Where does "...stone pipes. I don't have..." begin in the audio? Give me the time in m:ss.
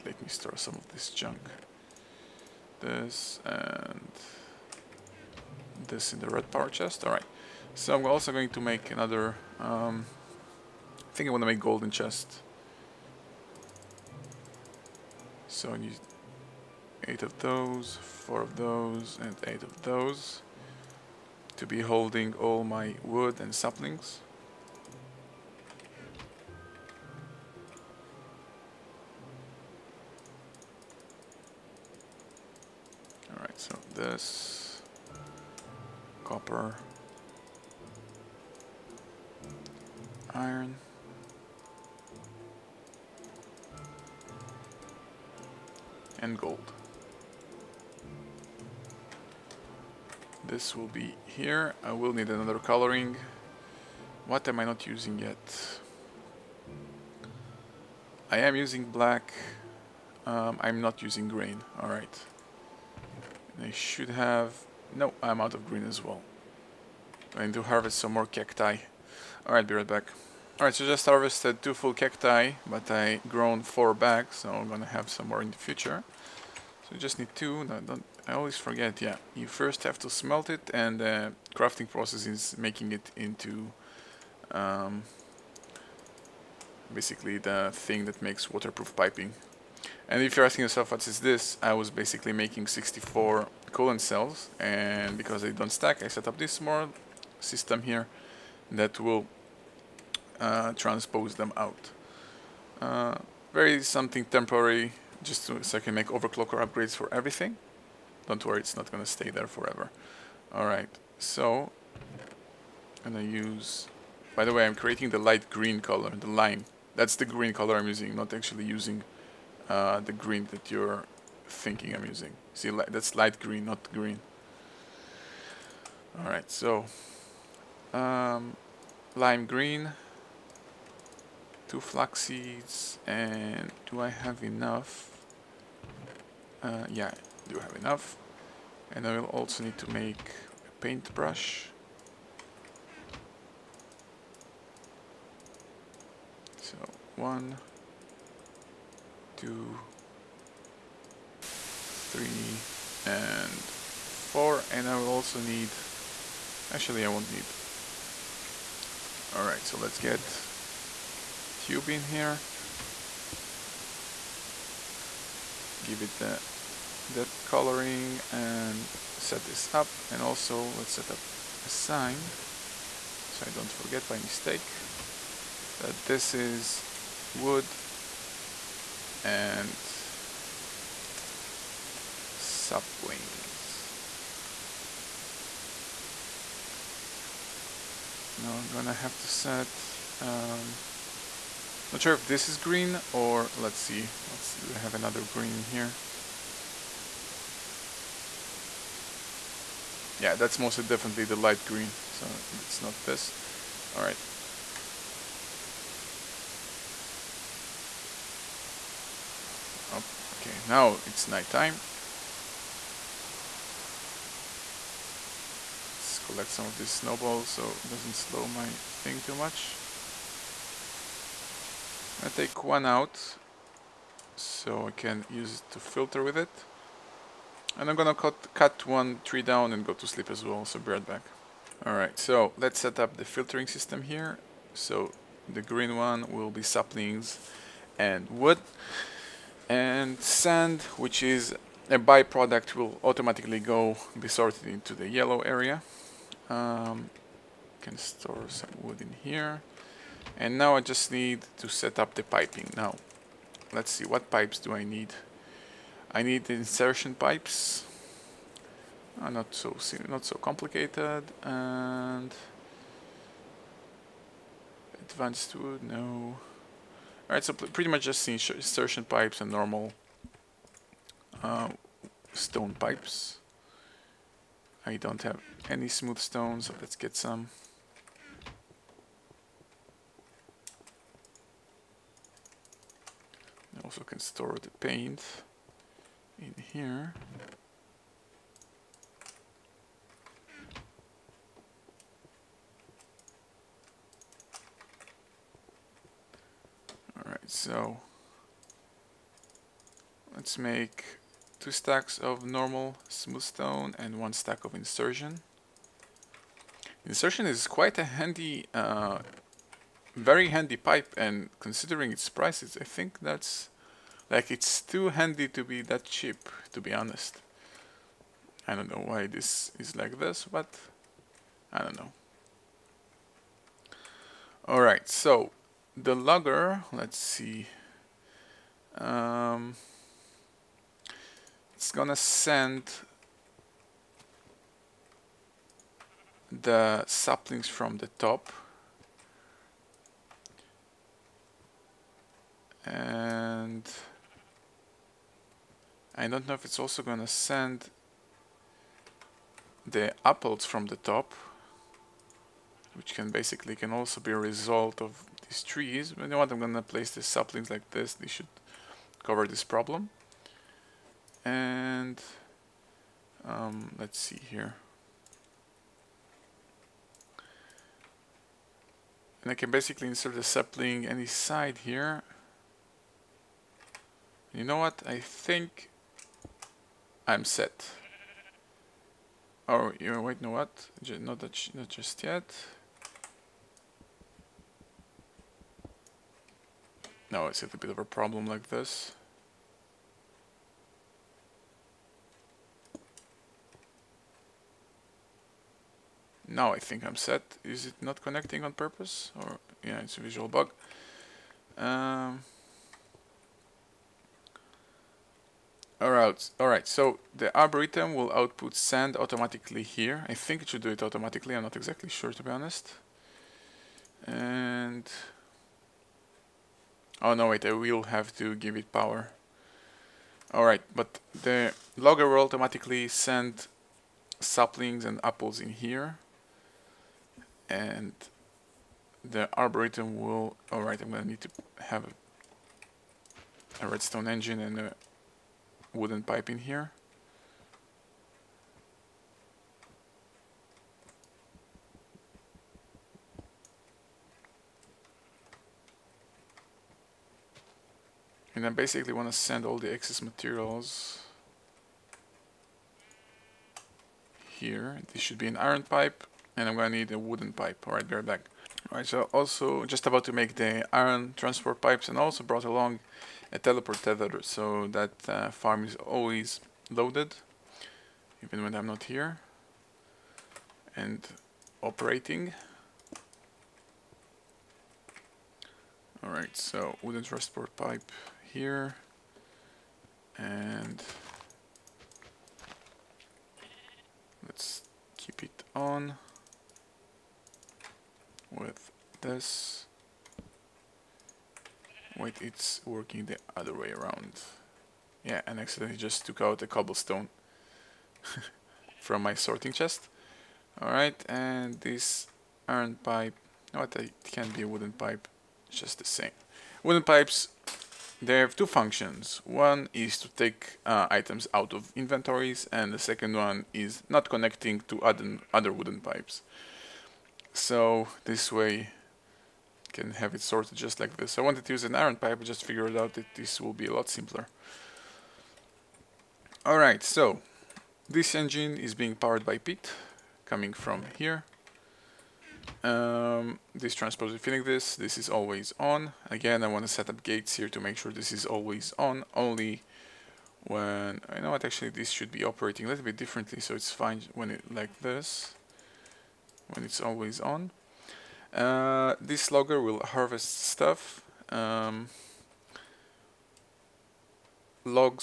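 4:32.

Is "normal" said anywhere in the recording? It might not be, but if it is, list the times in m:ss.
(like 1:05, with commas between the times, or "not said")
4:29, 5:02.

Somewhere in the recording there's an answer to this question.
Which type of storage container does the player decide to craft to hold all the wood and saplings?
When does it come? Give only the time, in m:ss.
0:11.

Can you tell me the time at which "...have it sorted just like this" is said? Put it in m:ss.
8:40.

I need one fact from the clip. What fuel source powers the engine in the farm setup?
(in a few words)
peat.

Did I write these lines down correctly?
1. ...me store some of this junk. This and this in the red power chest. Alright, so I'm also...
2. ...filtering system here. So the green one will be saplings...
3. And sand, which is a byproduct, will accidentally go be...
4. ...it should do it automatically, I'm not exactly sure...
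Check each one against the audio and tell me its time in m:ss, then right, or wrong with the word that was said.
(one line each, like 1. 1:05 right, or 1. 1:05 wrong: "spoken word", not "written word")
1. 0:00 right
2. 3:53 right
3. 3:59 wrong: "automatically", not "accidentally"
4. 6:50 right.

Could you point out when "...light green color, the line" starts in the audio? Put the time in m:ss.
1:55.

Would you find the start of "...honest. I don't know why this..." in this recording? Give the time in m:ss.
5:16.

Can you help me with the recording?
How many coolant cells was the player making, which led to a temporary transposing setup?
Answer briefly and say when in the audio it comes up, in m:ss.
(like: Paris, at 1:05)
64, at 1:32.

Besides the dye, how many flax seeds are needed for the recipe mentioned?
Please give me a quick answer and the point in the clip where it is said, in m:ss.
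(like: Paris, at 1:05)
2, at 2:11.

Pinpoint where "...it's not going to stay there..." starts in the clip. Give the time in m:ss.
1:48.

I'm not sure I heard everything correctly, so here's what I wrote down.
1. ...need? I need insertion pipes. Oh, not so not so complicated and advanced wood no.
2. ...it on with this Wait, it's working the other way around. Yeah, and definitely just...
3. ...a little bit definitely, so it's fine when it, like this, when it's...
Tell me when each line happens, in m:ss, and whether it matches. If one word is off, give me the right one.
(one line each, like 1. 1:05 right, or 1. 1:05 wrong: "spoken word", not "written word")
1. 4:14 right
2. 8:05 wrong: "accidentally", not "definitely"
3. 9:02 wrong: "differently", not "definitely".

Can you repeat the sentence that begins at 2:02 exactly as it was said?
See, li that's light green, not green.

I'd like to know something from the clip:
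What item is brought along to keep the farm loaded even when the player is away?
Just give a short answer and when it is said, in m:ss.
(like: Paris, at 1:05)
teleport tether, at 7:43.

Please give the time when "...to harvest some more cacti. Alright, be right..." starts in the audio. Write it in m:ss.
1:07.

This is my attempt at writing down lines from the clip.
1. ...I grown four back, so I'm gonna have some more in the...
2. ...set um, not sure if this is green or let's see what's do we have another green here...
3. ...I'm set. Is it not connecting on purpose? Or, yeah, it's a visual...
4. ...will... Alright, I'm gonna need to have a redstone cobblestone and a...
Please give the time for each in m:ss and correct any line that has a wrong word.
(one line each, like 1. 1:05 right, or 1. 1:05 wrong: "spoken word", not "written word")
1. 1:12 right
2. 3:09 right
3. 6:37 right
4. 7:10 wrong: "engine", not "cobblestone".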